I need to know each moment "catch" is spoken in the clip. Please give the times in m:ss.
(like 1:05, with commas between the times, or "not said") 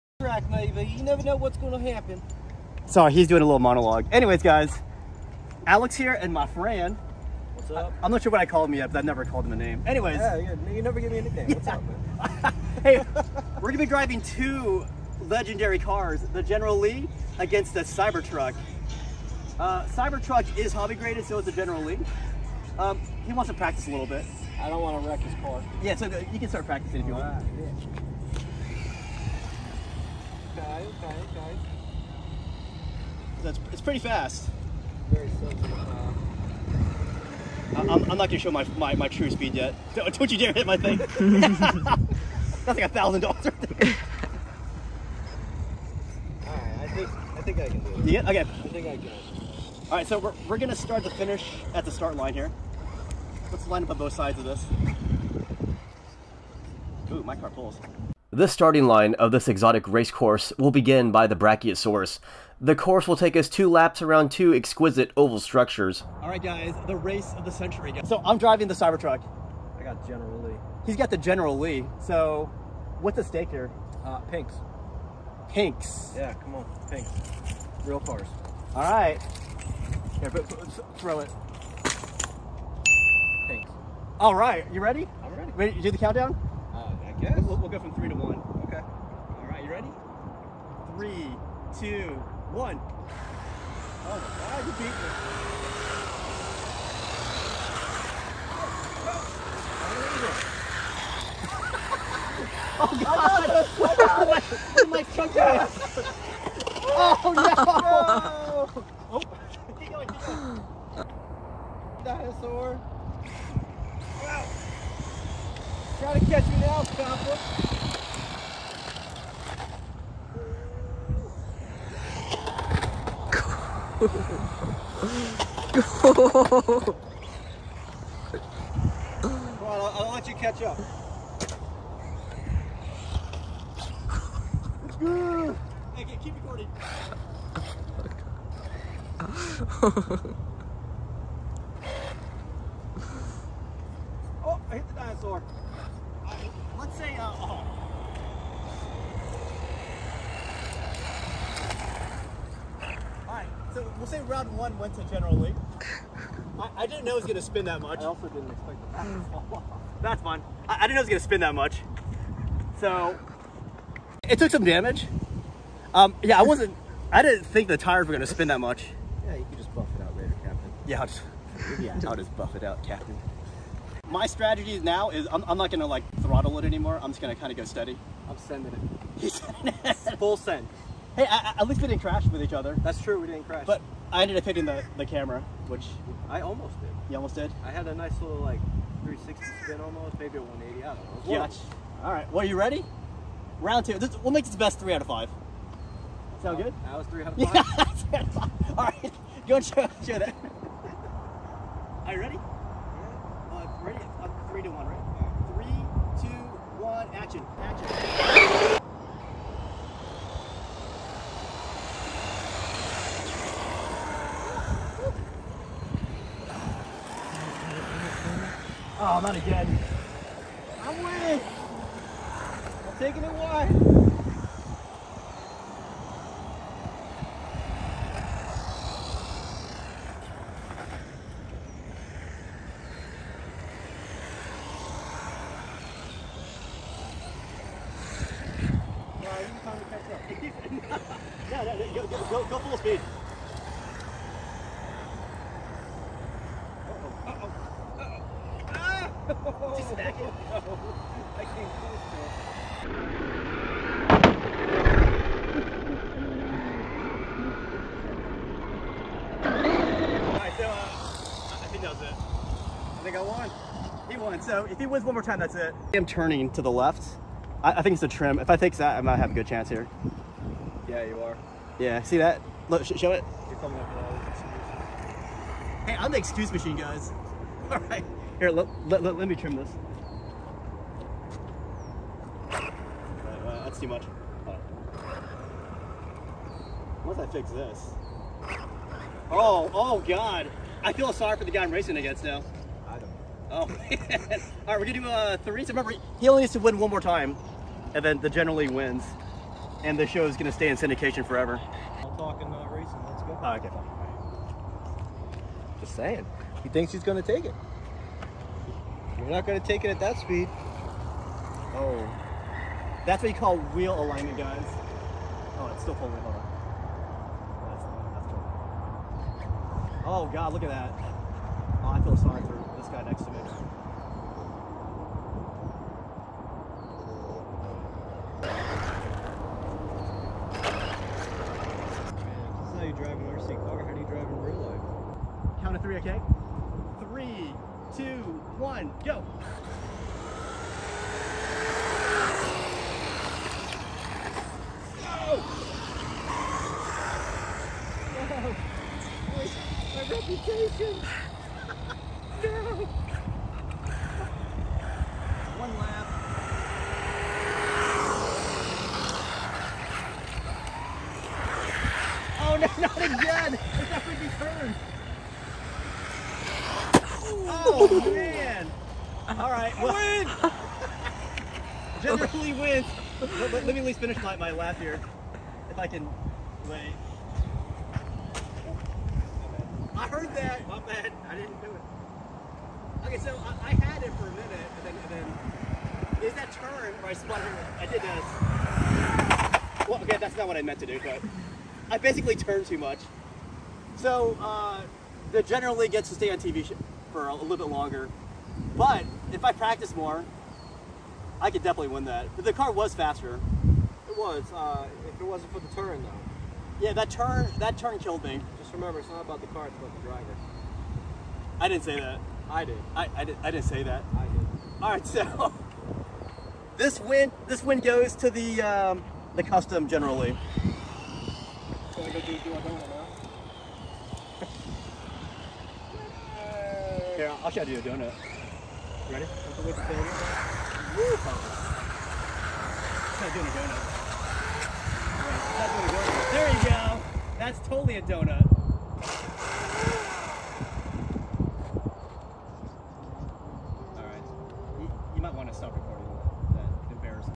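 1:56, 2:10.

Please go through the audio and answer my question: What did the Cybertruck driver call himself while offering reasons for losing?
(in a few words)
The excuse machine.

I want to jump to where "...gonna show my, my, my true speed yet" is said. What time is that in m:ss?
0:38.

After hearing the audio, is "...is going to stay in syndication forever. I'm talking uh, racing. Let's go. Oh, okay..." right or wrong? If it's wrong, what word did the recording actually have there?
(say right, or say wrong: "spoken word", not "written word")
right.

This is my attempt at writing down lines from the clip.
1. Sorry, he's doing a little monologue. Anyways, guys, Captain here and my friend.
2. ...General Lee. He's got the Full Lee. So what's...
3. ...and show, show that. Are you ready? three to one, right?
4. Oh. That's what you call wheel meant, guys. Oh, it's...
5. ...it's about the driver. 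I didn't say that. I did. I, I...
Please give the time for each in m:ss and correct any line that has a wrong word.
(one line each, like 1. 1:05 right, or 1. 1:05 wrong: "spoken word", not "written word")
1. 0:02 wrong: "Alex", not "Captain"
2. 1:10 wrong: "General", not "Full"
3. 3:19 right
4. 5:11 wrong: "alignment", not "meant"
5. 6:49 right.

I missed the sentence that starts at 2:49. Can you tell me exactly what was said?
Yeah, you can just buff it out later, Captain.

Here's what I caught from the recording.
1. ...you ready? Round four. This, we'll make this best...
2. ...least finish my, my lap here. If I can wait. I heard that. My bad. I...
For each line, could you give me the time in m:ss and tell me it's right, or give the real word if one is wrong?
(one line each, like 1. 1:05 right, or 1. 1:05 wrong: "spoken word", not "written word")
1. 3:12 wrong: "two", not "four"
2. 6:13 right.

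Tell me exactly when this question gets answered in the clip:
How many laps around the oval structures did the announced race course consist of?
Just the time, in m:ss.
1:03.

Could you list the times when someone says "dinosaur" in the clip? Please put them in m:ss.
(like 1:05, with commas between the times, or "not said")
1:52, 2:24.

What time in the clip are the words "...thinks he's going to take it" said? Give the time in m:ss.
5:06.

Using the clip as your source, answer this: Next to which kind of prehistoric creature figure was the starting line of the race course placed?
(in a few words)
Brachiosaurus.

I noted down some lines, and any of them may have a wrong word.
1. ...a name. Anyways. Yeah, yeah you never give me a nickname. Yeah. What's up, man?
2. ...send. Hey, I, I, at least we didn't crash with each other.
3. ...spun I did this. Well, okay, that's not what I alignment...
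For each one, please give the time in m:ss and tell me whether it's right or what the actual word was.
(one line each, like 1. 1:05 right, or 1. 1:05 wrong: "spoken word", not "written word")
1. 0:09 right
2. 3:00 right
3. 6:27 wrong: "meant", not "alignment".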